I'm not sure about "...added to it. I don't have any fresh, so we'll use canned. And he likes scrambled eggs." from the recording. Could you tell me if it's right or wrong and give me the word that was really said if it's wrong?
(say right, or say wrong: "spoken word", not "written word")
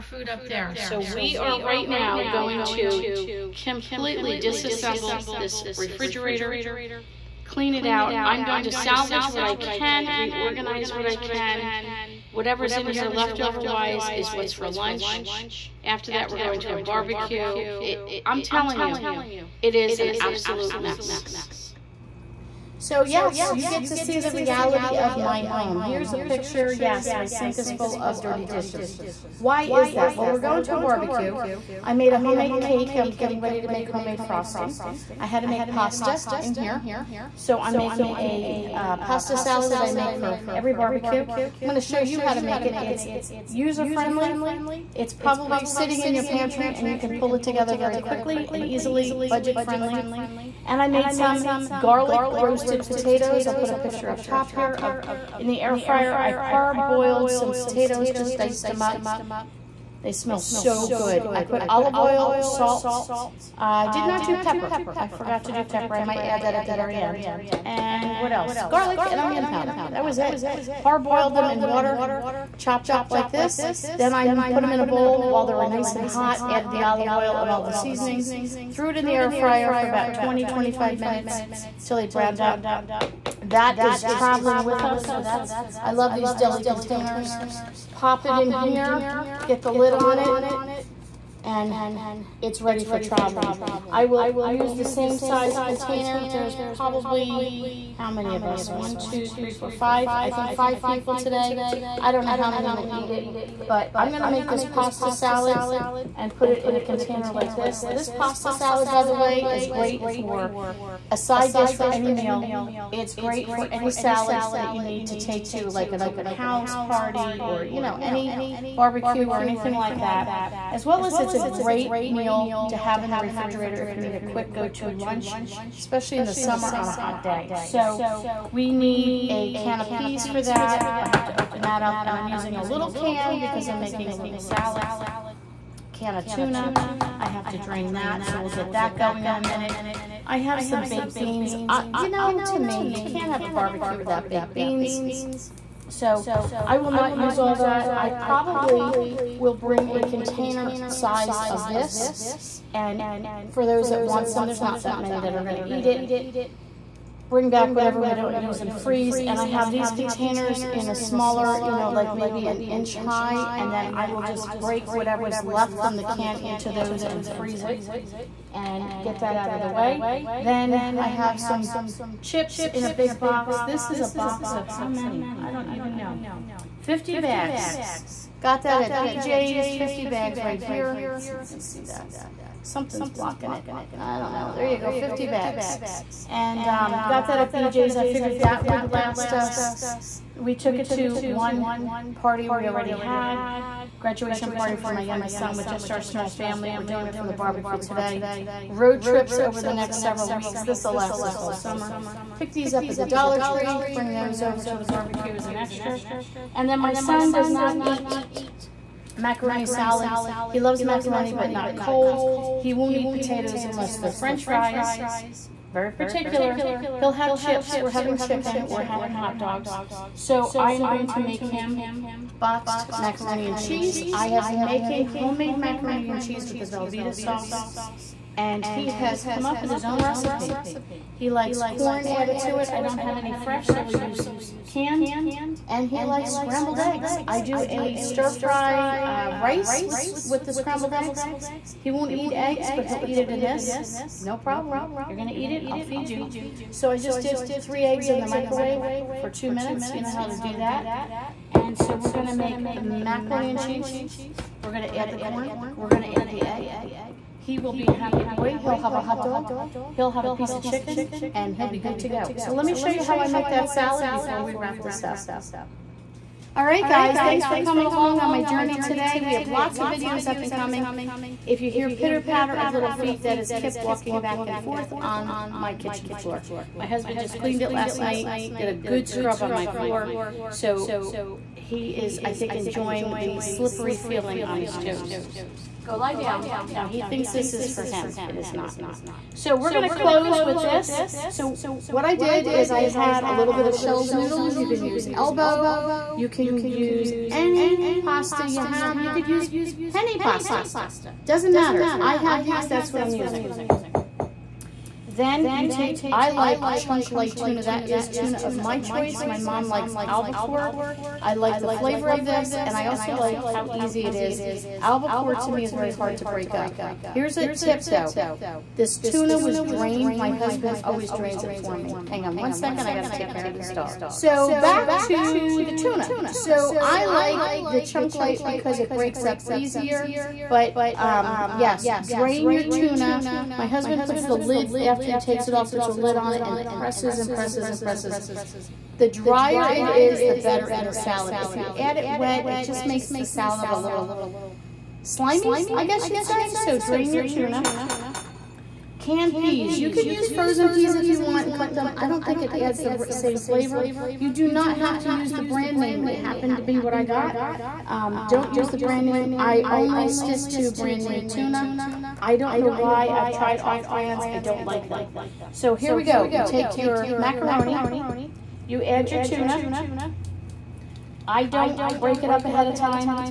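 right.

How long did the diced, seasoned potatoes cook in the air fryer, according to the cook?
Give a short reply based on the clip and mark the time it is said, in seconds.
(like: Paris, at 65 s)
20, 25 minutes, at 80 s.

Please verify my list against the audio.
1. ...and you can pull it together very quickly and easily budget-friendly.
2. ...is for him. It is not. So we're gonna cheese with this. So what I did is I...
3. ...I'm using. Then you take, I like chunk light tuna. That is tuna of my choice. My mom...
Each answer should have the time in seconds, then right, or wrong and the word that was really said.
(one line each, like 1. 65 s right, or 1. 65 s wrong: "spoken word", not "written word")
1. 46 s right
2. 287 s wrong: "close", not "cheese"
3. 303 s right.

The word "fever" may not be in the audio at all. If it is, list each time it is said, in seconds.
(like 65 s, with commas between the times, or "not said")
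not said.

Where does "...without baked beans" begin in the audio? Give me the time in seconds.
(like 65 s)
143 s.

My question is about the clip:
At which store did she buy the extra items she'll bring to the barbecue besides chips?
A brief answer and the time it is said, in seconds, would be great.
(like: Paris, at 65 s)
Dollar Tree, at 203 s.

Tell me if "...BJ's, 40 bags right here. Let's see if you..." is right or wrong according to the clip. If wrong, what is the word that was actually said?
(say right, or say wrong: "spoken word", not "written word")
wrong: "50", not "40".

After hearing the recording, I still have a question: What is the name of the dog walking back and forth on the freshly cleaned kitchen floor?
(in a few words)
Kip.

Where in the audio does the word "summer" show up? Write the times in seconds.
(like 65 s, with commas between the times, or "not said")
126 s, 201 s.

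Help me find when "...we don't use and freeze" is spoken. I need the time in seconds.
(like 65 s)
158 s.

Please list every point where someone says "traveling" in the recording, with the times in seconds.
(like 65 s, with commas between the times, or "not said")
84 s, 92 s.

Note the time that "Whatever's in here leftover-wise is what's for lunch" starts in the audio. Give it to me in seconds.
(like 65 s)
12 s.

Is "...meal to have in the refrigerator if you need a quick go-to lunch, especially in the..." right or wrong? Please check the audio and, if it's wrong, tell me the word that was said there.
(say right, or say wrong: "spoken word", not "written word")
right.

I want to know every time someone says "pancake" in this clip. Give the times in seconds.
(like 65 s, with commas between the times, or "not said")
not said.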